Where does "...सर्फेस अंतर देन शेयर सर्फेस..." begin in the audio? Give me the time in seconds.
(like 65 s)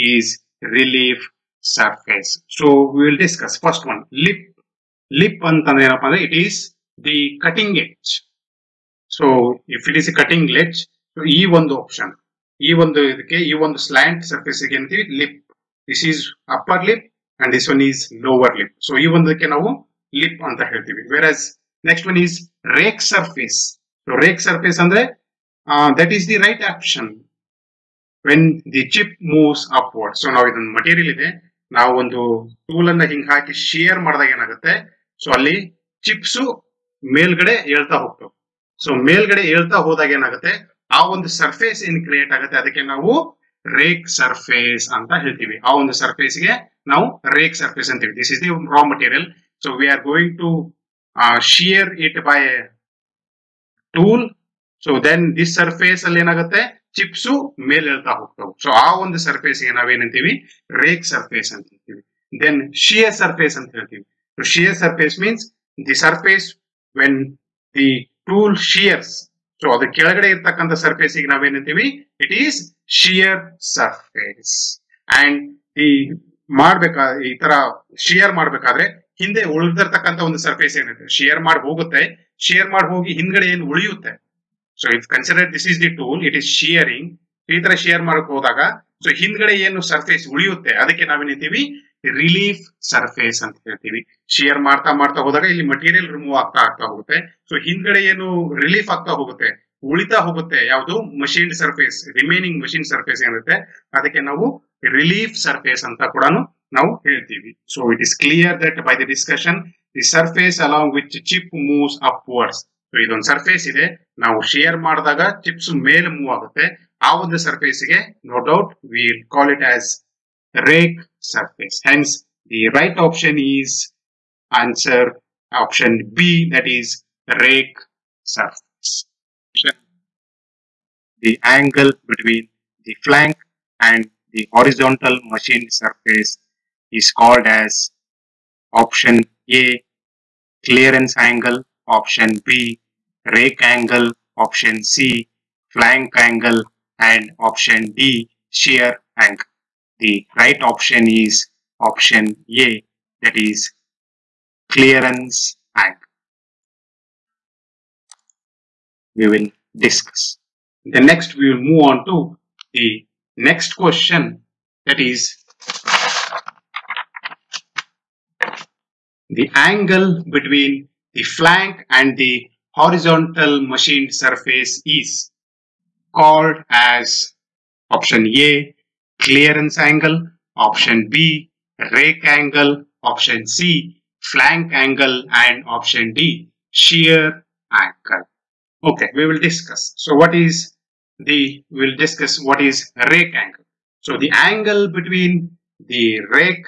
61 s.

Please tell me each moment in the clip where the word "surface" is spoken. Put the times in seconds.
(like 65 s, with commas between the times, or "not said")
121 s, 128 s, 135 s, 174 s.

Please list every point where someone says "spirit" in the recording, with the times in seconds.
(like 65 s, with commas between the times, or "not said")
not said.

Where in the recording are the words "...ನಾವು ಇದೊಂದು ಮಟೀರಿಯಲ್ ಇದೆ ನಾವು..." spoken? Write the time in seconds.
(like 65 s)
30 s.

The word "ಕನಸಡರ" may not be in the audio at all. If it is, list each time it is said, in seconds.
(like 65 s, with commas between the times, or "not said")
85 s.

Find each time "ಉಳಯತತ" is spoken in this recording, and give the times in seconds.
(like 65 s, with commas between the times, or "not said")
83 s, 90 s.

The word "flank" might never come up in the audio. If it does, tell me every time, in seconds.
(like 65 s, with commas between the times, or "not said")
133 s, 145 s, 171 s, 184 s.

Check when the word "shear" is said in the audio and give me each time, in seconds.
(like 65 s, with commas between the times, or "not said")
148 s, 186 s.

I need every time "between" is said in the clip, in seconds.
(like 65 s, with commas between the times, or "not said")
132 s, 170 s, 194 s.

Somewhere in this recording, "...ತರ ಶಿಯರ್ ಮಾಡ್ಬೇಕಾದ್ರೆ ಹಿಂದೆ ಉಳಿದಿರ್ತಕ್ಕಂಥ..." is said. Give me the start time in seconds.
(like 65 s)
77 s.